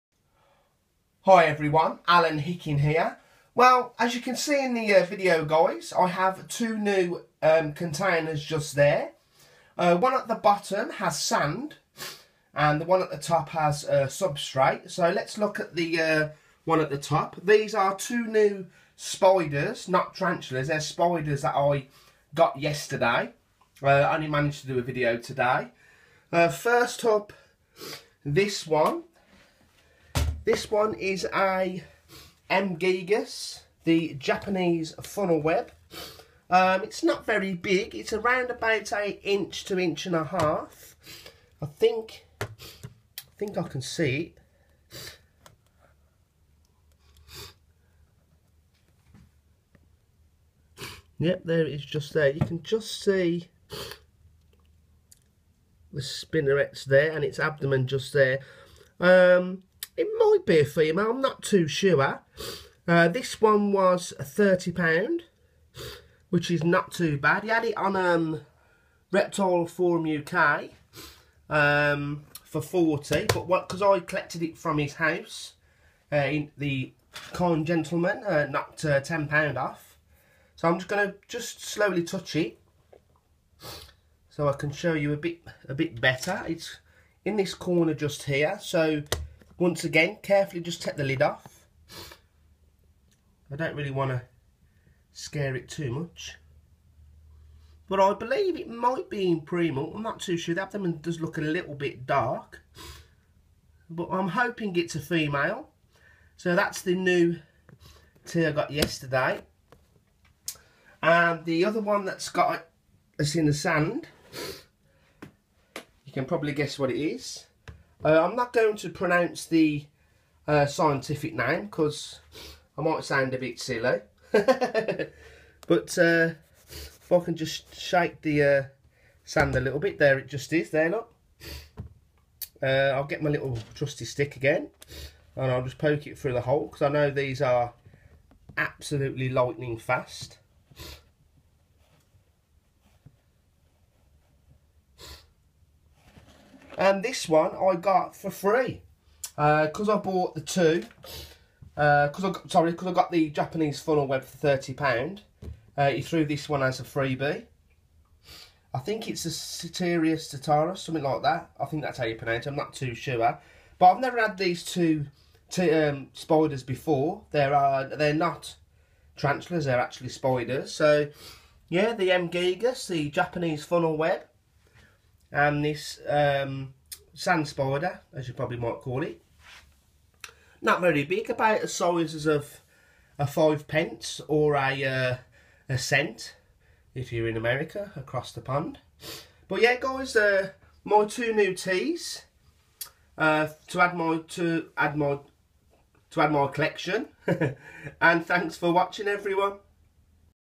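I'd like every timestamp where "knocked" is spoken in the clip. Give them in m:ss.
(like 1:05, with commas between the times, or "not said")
1:18.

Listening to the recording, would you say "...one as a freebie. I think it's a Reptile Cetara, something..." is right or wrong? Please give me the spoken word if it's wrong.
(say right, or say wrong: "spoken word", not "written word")
wrong: "Ceteria", not "Reptile".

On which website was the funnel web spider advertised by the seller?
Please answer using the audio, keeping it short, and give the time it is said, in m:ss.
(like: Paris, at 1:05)
Reptile Forum UK, at 1:09.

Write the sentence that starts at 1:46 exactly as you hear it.
So that's the new tea I got yesterday.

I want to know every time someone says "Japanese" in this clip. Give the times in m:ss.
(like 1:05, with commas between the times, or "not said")
0:34, 2:33, 2:53.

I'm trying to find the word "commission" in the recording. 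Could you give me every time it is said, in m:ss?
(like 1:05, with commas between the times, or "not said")
not said.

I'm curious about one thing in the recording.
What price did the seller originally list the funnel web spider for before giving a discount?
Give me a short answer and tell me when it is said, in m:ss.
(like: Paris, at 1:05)
£40, at 1:12.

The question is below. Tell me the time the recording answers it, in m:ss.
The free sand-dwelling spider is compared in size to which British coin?
3:03.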